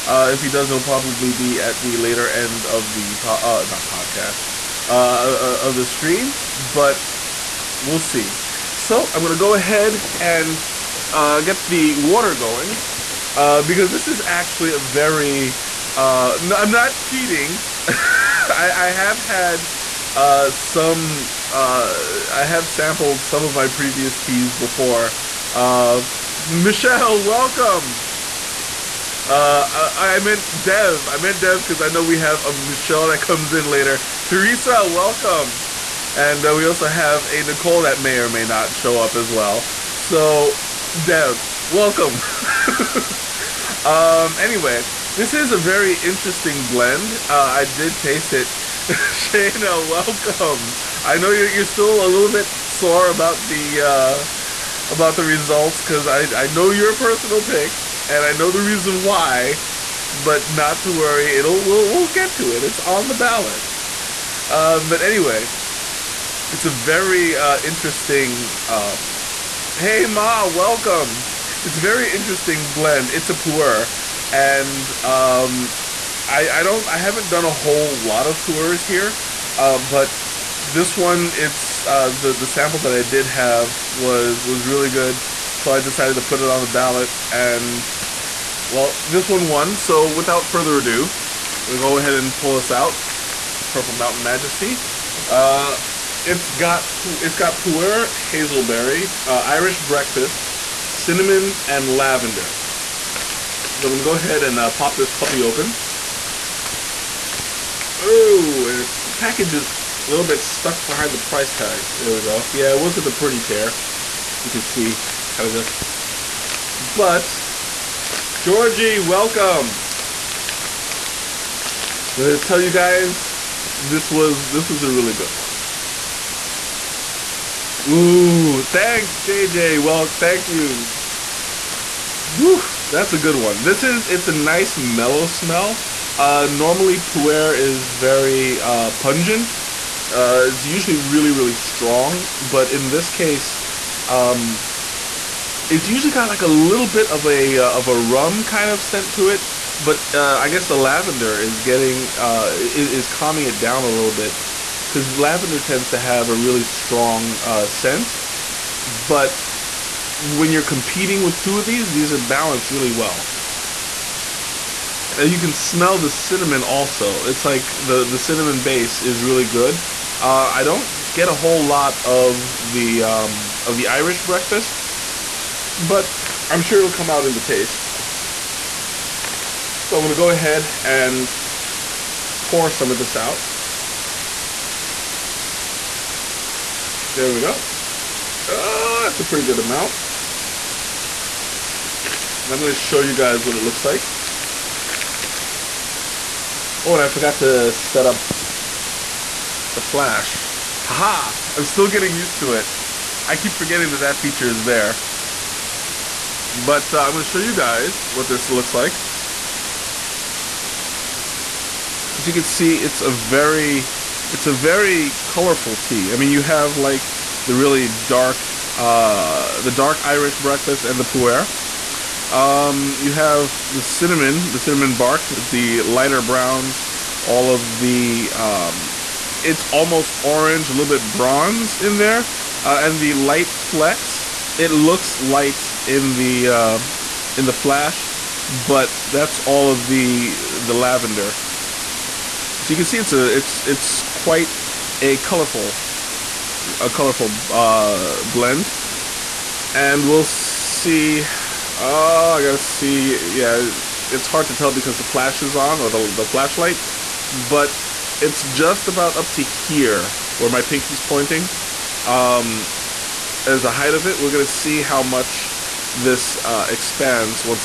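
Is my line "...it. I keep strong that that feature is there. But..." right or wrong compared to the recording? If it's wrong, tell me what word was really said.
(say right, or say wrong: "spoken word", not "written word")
wrong: "forgetting", not "strong".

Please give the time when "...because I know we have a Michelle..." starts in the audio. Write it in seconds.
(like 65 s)
31 s.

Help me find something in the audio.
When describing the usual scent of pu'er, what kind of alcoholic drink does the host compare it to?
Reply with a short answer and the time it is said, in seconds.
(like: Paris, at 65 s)
Rum, at 147 s.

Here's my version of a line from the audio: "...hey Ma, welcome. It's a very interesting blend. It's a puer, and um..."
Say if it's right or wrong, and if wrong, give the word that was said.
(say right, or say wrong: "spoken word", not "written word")
right.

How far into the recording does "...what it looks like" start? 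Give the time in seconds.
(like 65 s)
193 s.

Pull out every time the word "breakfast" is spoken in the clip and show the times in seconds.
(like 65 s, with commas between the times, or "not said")
99 s, 174 s, 220 s.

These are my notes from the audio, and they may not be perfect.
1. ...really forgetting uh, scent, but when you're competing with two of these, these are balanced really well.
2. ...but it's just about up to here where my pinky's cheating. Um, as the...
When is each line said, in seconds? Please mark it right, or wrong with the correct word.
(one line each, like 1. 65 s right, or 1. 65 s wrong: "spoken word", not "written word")
1. 156 s wrong: "strong", not "forgetting"
2. 257 s wrong: "pointing", not "cheating".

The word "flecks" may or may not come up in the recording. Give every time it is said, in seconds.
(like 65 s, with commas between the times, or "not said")
233 s.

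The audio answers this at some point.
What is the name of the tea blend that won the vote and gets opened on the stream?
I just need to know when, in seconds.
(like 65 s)
93 s.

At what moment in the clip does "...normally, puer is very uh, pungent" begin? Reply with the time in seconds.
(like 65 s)
136 s.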